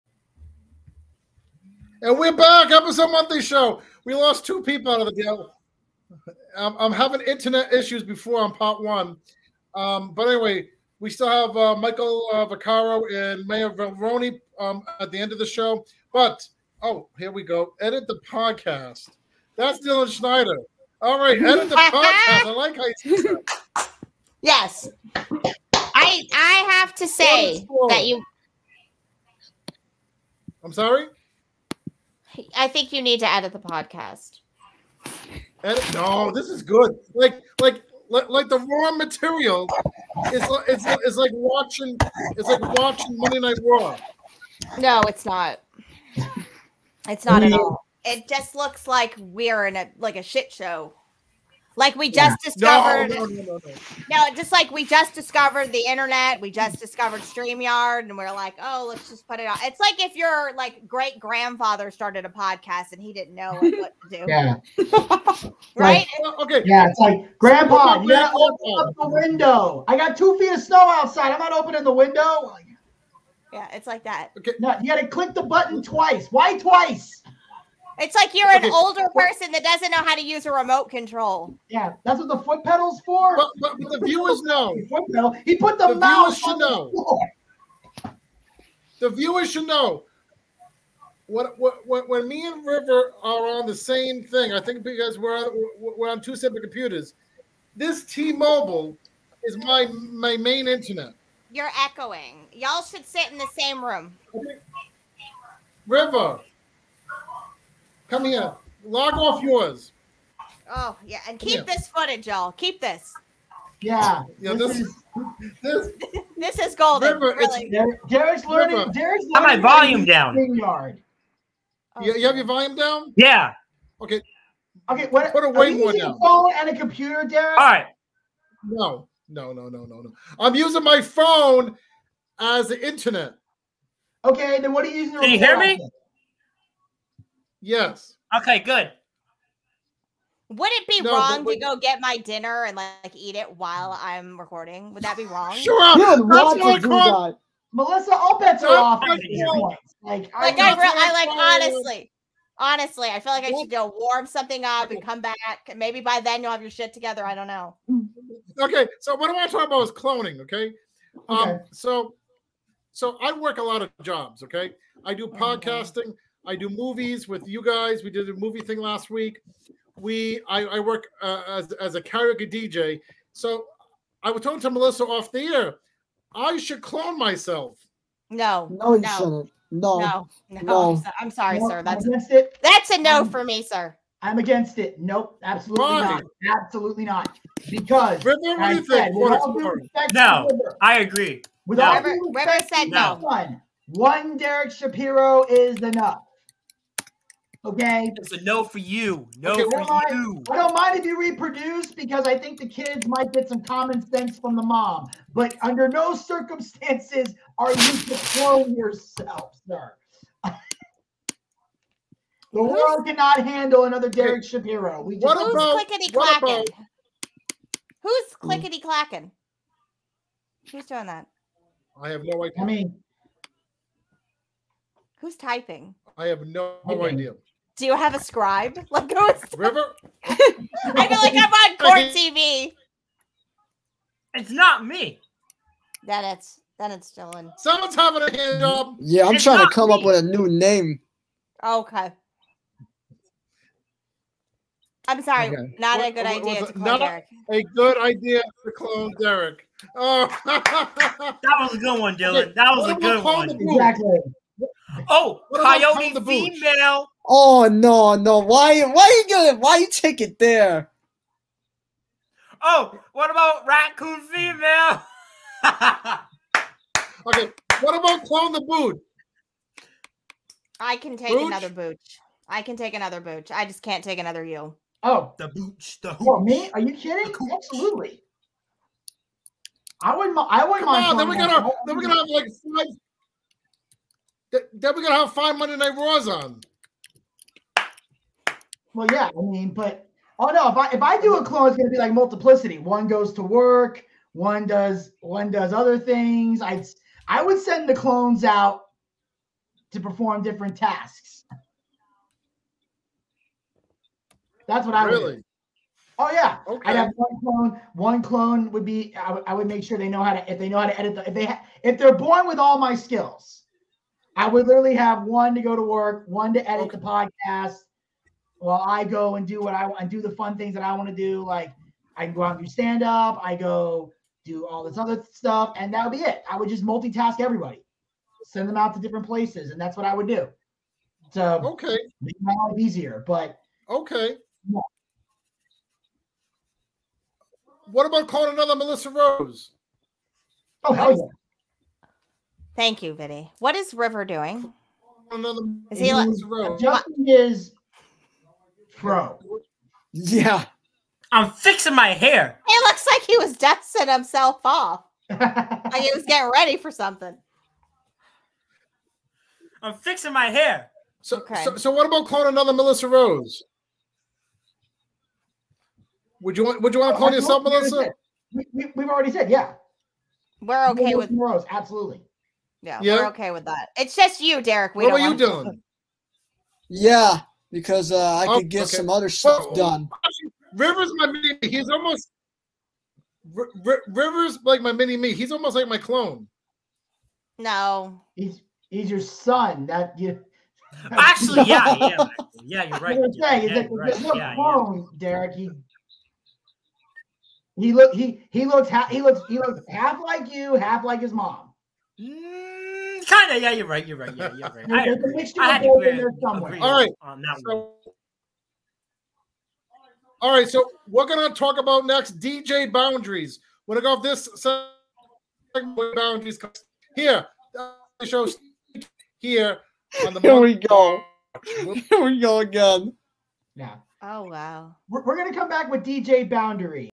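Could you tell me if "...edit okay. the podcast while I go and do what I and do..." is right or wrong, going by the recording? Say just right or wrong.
right.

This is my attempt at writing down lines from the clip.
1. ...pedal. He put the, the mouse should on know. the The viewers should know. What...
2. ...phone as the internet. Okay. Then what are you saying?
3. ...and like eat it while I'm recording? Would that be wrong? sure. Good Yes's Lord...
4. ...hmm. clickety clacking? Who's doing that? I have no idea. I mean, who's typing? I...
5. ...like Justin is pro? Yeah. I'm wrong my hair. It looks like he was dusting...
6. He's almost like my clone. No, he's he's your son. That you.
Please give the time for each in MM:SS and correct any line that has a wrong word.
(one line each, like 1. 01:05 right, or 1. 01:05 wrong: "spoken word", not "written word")
1. 01:25 right
2. 02:11 wrong: "using", not "saying"
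3. 02:22 wrong: "That", not "Yes"
4. 03:38 right
5. 05:46 wrong: "fixing", not "wrong"
6. 06:25 right.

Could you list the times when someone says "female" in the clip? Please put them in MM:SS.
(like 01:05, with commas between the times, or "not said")
04:16, 04:24.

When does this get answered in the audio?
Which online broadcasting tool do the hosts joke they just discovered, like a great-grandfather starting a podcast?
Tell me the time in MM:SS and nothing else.
00:57.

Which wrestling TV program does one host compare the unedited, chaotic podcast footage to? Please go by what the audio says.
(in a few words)
Monday Night Raw.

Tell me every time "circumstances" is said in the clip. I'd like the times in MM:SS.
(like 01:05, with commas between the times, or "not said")
03:26.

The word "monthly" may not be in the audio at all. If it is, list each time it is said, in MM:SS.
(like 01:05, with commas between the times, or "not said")
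00:03.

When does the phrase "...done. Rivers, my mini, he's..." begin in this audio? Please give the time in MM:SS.
06:19.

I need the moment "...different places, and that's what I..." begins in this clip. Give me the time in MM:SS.
05:29.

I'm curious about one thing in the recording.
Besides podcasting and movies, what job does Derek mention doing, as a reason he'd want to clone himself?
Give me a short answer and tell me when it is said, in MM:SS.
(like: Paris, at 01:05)
karaoke DJ, at 02:52.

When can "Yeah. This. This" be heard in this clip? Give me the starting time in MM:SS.
01:54.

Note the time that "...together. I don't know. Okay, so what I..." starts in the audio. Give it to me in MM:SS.
02:36.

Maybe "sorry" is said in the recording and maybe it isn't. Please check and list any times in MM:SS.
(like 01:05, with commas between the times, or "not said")
00:30, 03:01, 04:05.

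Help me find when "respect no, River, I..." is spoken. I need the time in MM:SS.
03:09.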